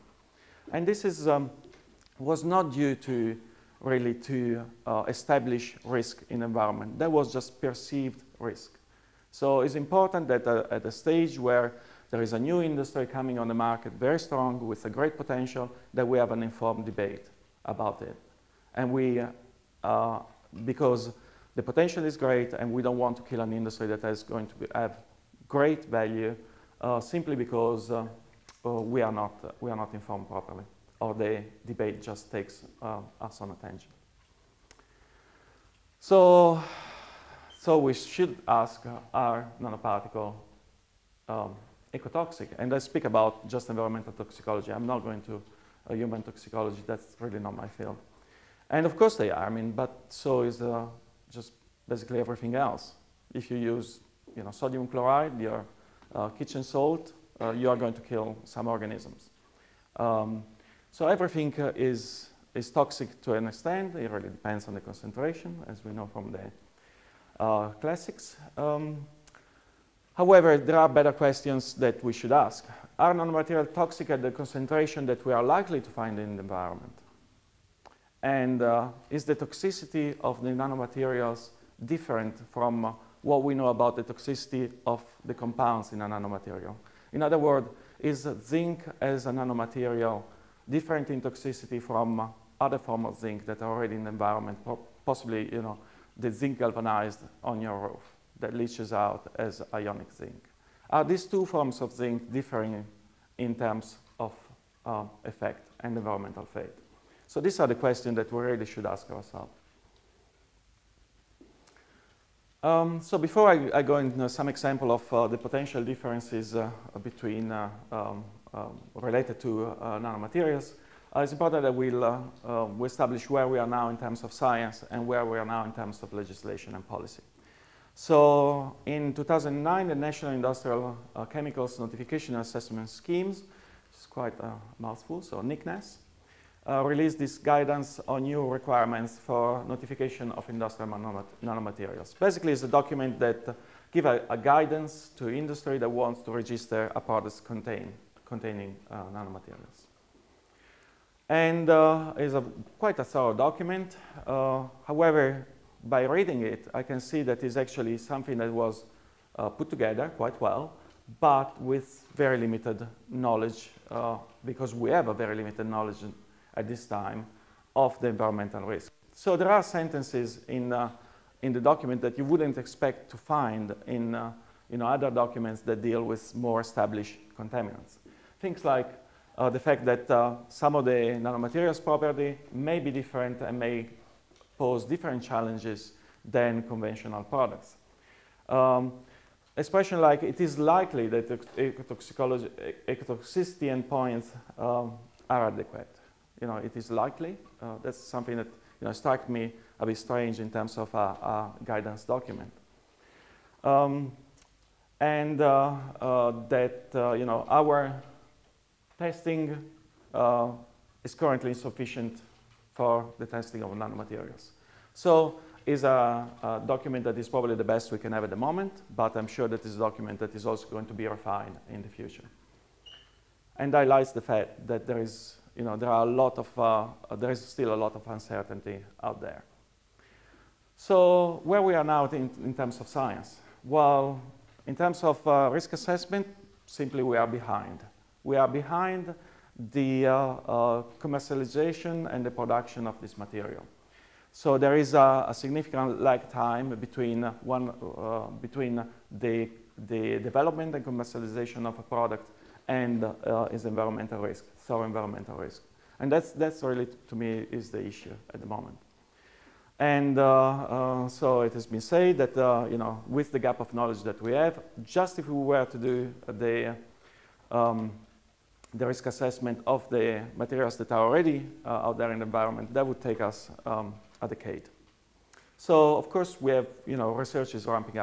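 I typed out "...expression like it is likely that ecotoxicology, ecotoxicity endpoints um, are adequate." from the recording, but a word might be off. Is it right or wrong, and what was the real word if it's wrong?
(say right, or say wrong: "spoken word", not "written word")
right.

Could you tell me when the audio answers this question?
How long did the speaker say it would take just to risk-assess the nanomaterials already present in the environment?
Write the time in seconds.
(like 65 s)
274 s.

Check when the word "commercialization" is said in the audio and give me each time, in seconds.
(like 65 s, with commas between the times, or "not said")
240 s, 250 s.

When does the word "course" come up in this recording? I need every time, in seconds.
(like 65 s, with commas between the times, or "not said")
48 s, 276 s.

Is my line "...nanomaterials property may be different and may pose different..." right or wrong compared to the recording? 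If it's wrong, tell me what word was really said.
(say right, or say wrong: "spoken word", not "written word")
right.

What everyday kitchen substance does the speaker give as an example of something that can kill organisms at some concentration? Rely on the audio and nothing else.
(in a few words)
Sodium chloride.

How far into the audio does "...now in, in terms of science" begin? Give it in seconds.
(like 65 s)
231 s.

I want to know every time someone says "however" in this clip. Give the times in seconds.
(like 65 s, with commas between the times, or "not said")
70 s, 154 s.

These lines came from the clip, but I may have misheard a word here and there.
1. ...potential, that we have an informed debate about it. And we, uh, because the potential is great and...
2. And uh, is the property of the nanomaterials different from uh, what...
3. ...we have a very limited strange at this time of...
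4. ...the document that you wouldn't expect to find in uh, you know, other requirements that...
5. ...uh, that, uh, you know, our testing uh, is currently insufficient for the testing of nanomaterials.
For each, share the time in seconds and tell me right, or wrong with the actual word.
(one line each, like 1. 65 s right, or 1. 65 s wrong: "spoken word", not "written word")
1. 15 s right
2. 78 s wrong: "toxicity", not "property"
3. 164 s wrong: "knowledge", not "strange"
4. 171 s wrong: "documents", not "requirements"
5. 205 s right.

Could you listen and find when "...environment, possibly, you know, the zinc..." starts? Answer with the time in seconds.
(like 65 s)
94 s.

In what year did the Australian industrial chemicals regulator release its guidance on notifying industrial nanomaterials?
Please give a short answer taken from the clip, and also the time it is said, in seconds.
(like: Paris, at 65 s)
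2009, at 129 s.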